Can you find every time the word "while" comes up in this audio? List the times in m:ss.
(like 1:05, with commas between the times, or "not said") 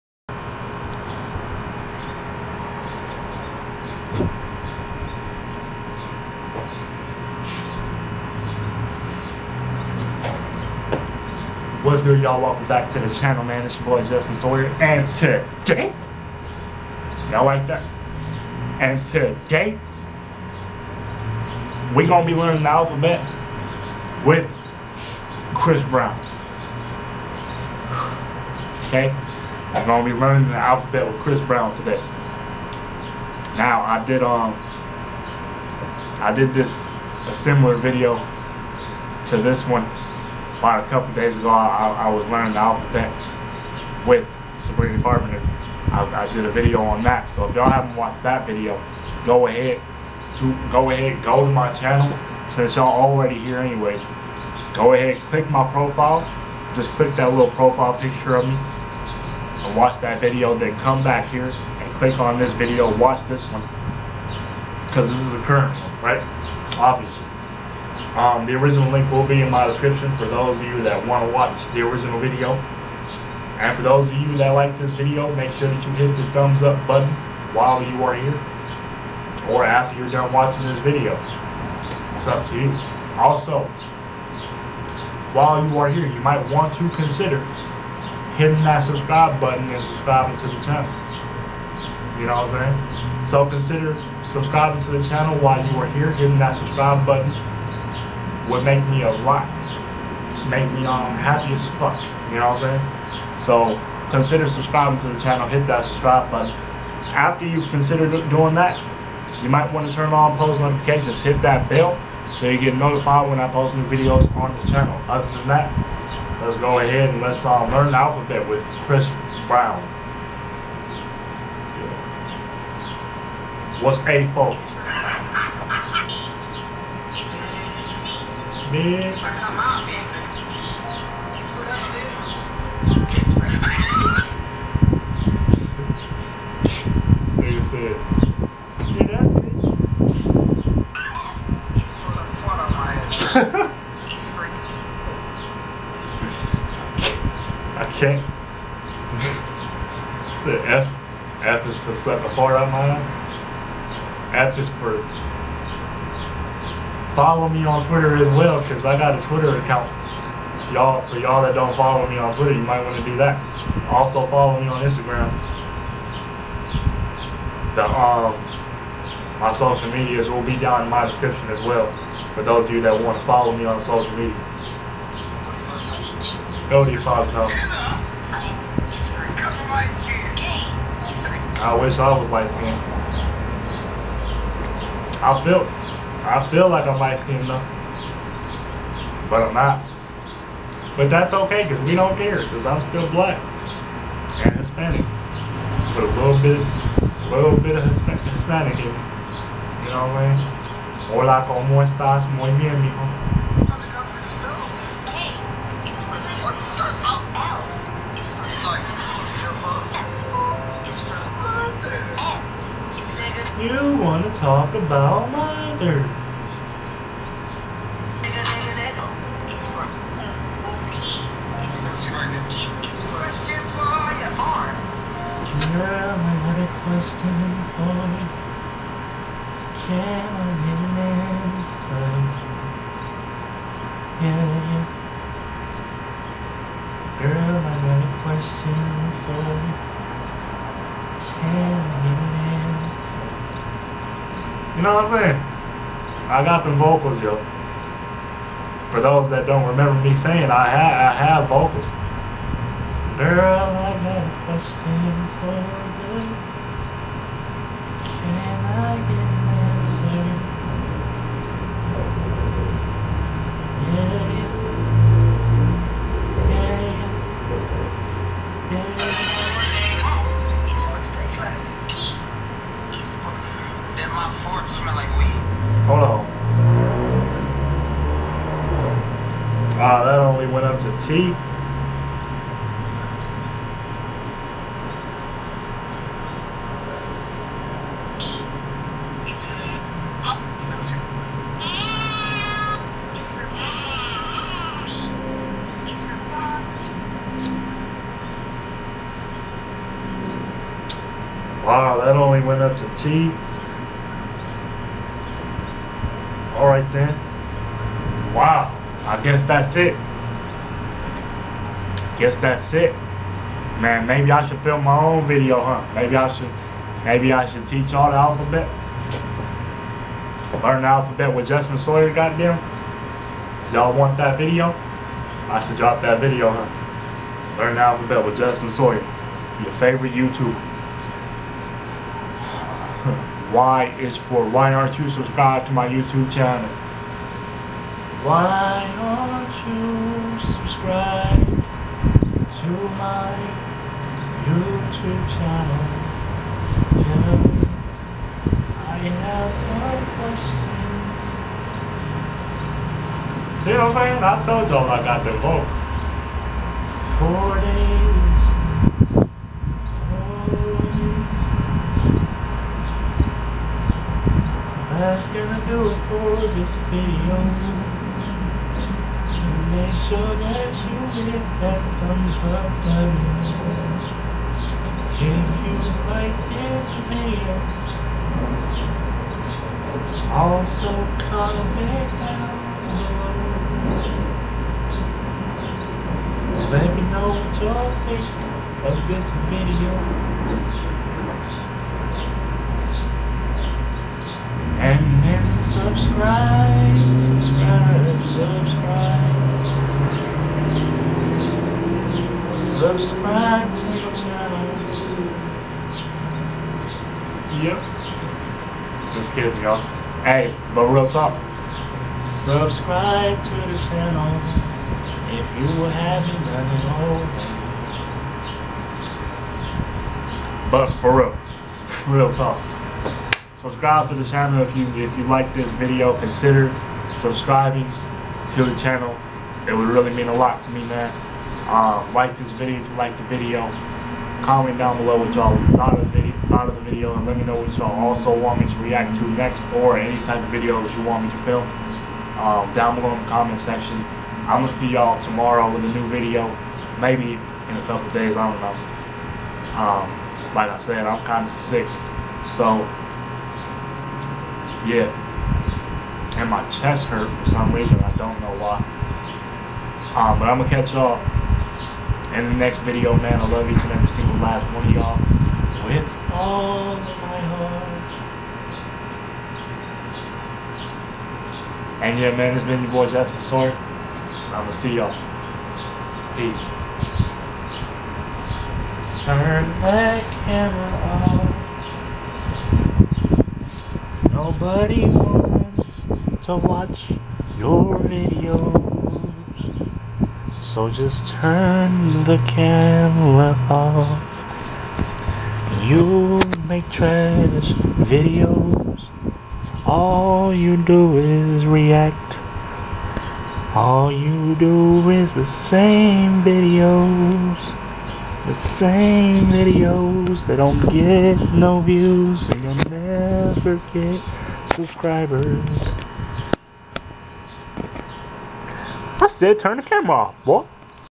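1:17, 1:25, 1:35.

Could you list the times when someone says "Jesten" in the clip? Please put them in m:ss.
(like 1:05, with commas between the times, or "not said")
0:14, 5:21, 5:28.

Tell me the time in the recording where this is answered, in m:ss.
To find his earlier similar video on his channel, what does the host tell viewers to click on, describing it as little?
0:57.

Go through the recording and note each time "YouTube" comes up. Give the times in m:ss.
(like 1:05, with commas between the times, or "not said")
5:30, 5:35.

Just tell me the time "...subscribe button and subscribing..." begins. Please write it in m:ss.
1:28.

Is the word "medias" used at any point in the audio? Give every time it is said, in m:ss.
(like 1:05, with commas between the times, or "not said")
2:49, 2:54.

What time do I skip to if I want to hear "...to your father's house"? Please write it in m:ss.
2:56.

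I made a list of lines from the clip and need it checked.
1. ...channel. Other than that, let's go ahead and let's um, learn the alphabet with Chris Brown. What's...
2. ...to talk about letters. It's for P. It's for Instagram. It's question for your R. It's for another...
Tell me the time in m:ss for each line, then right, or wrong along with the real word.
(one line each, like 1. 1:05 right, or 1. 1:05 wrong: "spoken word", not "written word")
1. 1:54 right
2. 3:34 wrong: "Kid", not "Instagram".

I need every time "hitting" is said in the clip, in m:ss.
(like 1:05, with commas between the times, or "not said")
1:28, 1:36.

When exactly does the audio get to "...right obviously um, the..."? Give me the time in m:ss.
1:06.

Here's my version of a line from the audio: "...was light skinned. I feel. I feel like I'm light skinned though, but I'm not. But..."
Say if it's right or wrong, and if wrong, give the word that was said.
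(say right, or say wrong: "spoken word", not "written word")
right.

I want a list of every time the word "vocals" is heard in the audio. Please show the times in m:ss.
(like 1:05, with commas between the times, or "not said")
4:06, 4:11.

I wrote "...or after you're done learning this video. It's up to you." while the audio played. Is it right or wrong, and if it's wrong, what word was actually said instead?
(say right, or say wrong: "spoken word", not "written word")
wrong: "watching", not "learning".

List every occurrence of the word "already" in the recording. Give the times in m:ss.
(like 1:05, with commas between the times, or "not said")
0:52, 7:00.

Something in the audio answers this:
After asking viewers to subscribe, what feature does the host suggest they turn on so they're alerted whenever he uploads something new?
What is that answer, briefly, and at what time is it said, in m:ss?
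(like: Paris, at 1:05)
post notifications, at 1:50.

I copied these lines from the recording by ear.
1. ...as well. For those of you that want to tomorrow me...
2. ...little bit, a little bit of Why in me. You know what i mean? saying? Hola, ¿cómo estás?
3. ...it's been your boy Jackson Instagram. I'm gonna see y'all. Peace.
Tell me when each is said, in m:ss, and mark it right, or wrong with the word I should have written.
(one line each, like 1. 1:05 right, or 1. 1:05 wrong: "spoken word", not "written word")
1. 2:51 wrong: "follow", not "tomorrow"
2. 3:16 wrong: "Hispanic", not "Why"
3. 7:52 wrong: "Sorn", not "Instagram".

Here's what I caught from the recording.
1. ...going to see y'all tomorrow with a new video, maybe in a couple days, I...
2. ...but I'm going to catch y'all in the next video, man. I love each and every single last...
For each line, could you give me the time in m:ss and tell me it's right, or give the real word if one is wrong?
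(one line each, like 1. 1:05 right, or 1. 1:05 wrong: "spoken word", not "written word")
1. 7:24 right
2. 7:40 right.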